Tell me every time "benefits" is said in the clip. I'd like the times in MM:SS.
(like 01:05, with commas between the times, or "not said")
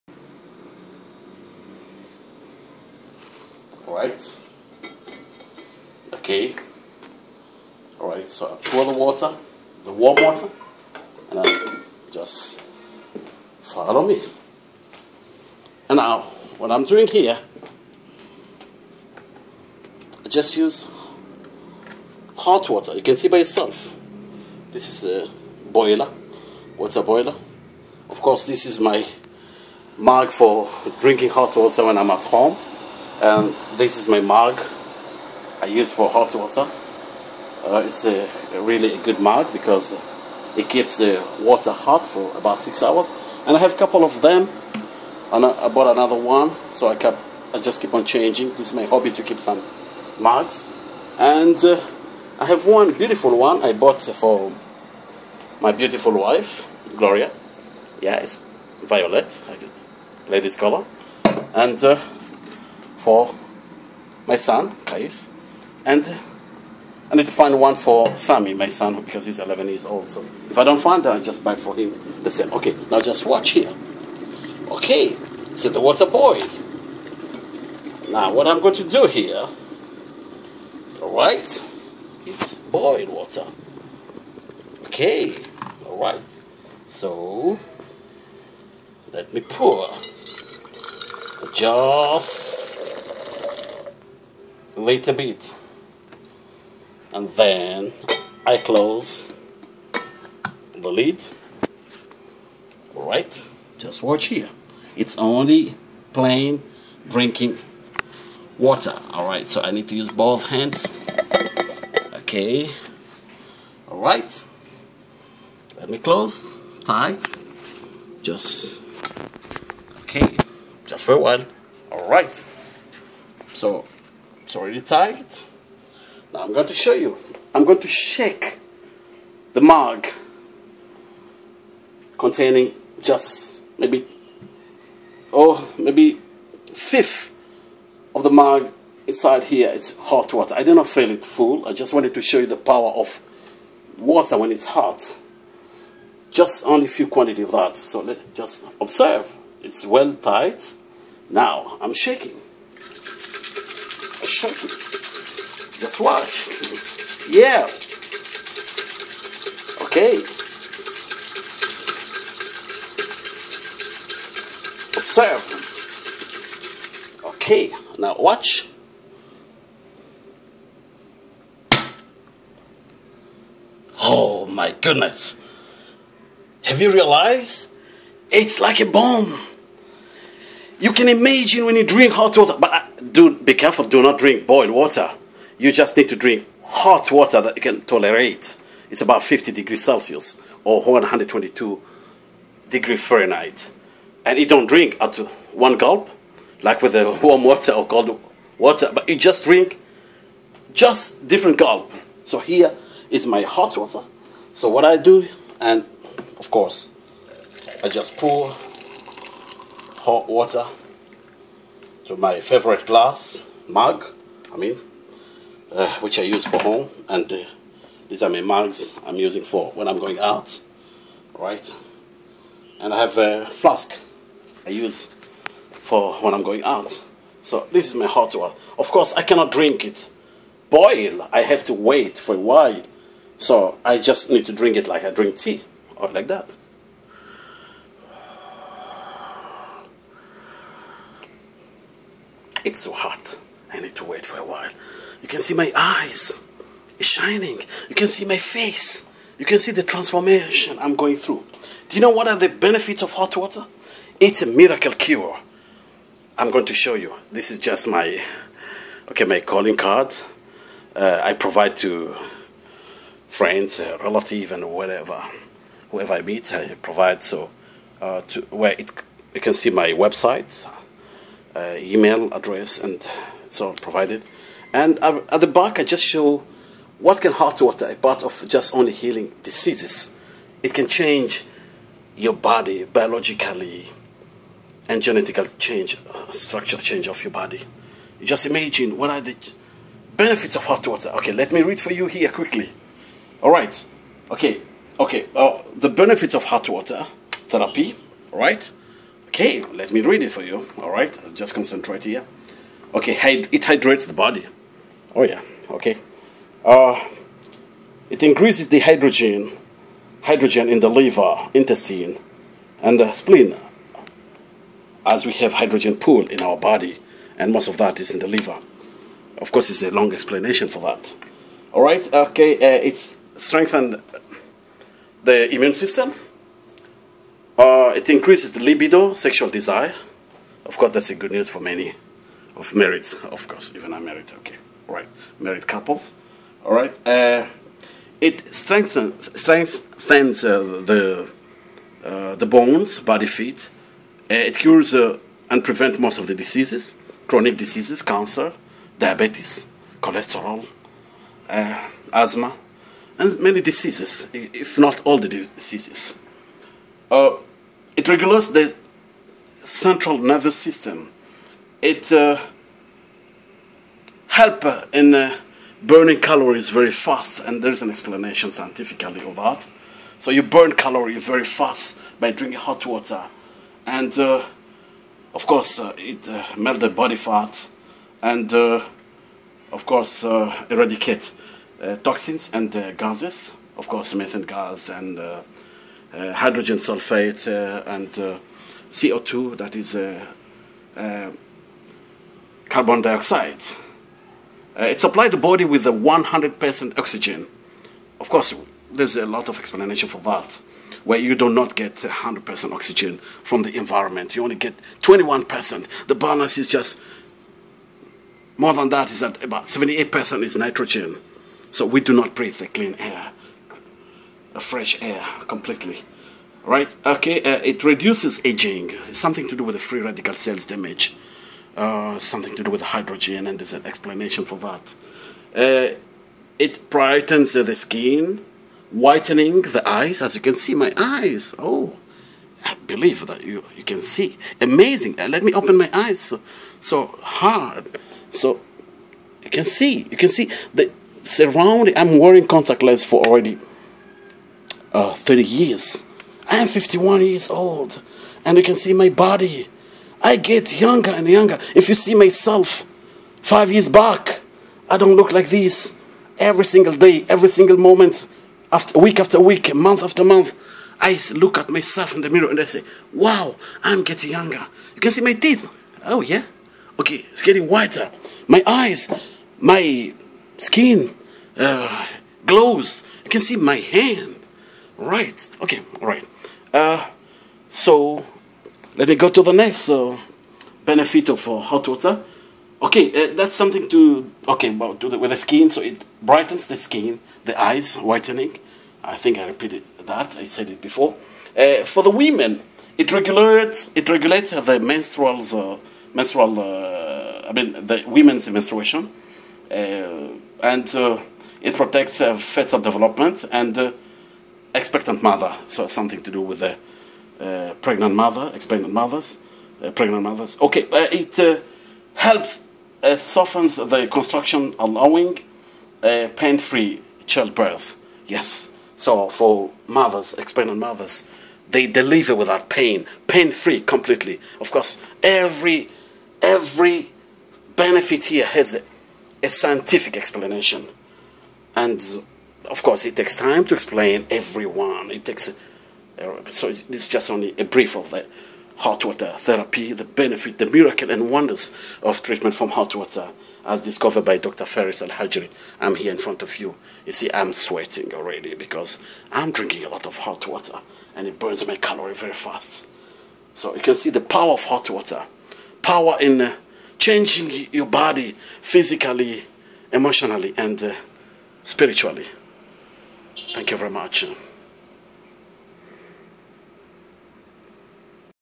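04:12, 04:50, 04:55, 08:00, 08:47, 09:00.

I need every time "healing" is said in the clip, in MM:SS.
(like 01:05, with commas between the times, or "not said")
04:38.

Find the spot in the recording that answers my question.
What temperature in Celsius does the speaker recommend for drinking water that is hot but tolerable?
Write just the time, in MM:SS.
03:09.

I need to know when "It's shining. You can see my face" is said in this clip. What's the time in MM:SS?
04:06.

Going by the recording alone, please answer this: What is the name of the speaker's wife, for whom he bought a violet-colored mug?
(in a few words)
Gloria.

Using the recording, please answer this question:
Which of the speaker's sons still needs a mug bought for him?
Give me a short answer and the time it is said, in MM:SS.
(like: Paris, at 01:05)
Sami, at 01:08.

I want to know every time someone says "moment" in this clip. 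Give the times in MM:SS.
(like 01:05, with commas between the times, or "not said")
07:37.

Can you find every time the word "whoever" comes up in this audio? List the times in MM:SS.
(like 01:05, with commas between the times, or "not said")
04:25.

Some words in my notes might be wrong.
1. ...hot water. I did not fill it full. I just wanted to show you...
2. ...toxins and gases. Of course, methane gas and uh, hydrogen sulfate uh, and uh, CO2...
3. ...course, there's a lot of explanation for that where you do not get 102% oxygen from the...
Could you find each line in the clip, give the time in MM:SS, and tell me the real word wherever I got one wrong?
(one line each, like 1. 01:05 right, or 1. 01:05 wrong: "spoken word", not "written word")
1. 02:20 right
2. 06:22 right
3. 06:38 wrong: "100", not "102".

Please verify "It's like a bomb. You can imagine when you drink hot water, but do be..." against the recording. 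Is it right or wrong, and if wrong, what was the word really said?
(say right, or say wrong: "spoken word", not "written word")
right.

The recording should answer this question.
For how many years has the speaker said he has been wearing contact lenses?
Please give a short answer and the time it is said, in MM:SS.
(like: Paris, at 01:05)
30, at 07:25.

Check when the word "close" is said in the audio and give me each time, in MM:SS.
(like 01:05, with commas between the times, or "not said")
01:38, 01:55.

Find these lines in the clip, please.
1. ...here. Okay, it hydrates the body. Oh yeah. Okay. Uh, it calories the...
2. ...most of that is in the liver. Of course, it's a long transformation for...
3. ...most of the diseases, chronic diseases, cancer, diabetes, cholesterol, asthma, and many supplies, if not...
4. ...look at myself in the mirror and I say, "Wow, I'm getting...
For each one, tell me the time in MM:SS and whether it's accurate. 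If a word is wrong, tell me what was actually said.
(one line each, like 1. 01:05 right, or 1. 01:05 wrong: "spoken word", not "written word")
1. 05:02 wrong: "increases", not "calories"
2. 05:17 wrong: "explanation", not "transformation"
3. 05:45 wrong: "diseases", not "supplies"
4. 07:41 right.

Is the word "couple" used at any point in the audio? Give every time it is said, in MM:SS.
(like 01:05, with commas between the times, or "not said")
00:43, 05:35.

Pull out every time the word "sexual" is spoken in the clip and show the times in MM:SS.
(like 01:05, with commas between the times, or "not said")
05:29.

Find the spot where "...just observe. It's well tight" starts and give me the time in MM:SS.
02:28.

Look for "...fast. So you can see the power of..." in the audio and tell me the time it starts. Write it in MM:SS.
09:12.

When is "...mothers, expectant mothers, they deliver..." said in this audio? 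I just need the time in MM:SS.
08:39.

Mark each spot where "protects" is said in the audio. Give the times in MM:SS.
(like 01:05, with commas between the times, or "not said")
08:21.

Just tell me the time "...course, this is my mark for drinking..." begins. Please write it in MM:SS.
00:28.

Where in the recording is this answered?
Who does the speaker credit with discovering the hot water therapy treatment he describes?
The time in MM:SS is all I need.
09:04.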